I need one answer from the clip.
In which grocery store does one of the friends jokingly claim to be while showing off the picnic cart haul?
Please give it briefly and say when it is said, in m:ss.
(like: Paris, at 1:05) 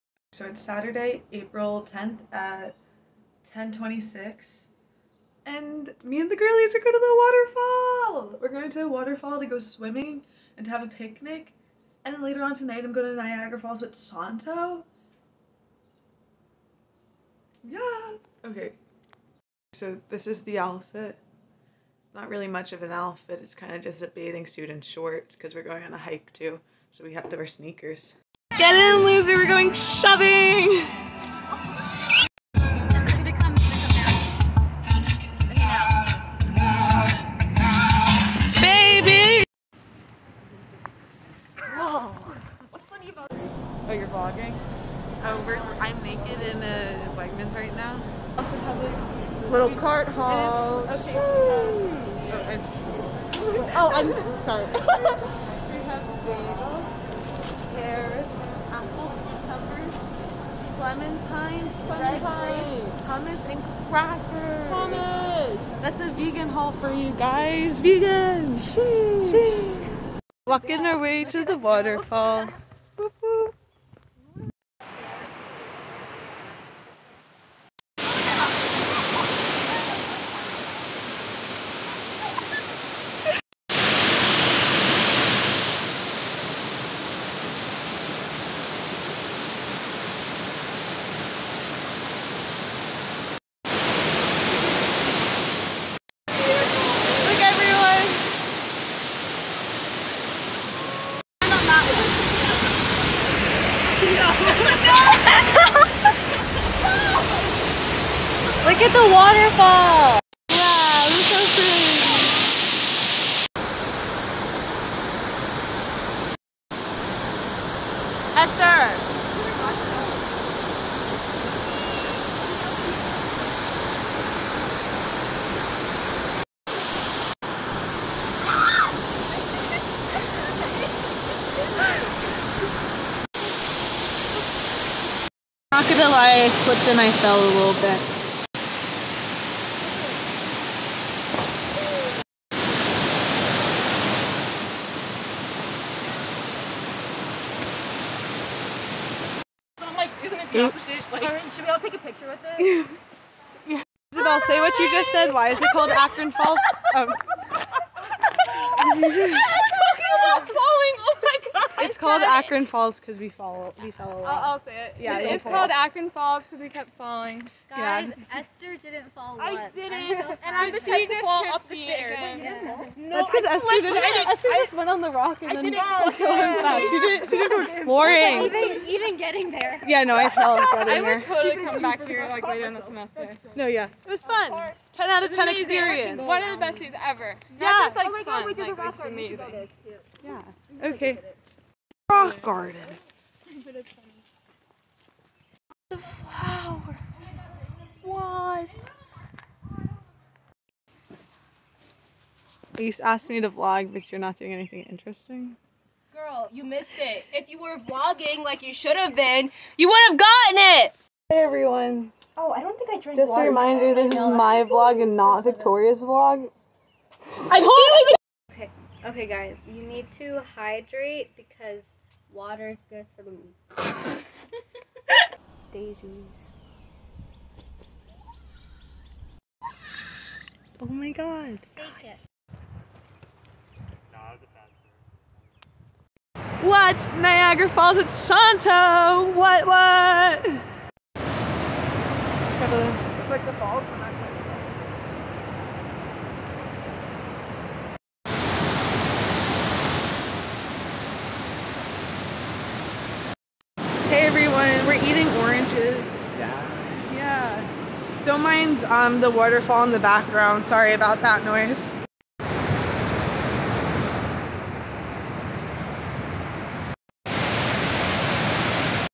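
Wegmans, at 0:47.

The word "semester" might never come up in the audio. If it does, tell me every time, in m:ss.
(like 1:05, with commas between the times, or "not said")
3:02.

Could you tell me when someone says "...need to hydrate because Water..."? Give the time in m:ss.
3:39.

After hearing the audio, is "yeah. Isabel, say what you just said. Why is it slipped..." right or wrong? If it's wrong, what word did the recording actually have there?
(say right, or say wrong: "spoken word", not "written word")
wrong: "called", not "slipped".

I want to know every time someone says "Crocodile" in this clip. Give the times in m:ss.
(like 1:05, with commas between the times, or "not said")
2:15.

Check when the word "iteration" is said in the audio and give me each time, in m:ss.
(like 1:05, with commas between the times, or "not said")
not said.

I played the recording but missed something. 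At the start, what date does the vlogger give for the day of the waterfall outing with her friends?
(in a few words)
Saturday, April 10th.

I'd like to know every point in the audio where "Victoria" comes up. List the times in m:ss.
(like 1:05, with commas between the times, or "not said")
3:35.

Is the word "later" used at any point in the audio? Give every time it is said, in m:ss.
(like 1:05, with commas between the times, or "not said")
0:12, 3:02.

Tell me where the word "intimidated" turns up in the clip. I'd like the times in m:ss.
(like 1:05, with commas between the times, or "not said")
not said.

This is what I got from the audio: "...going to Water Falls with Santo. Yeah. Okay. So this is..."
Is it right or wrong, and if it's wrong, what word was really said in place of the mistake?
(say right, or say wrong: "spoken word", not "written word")
wrong: "Niagara", not "Water".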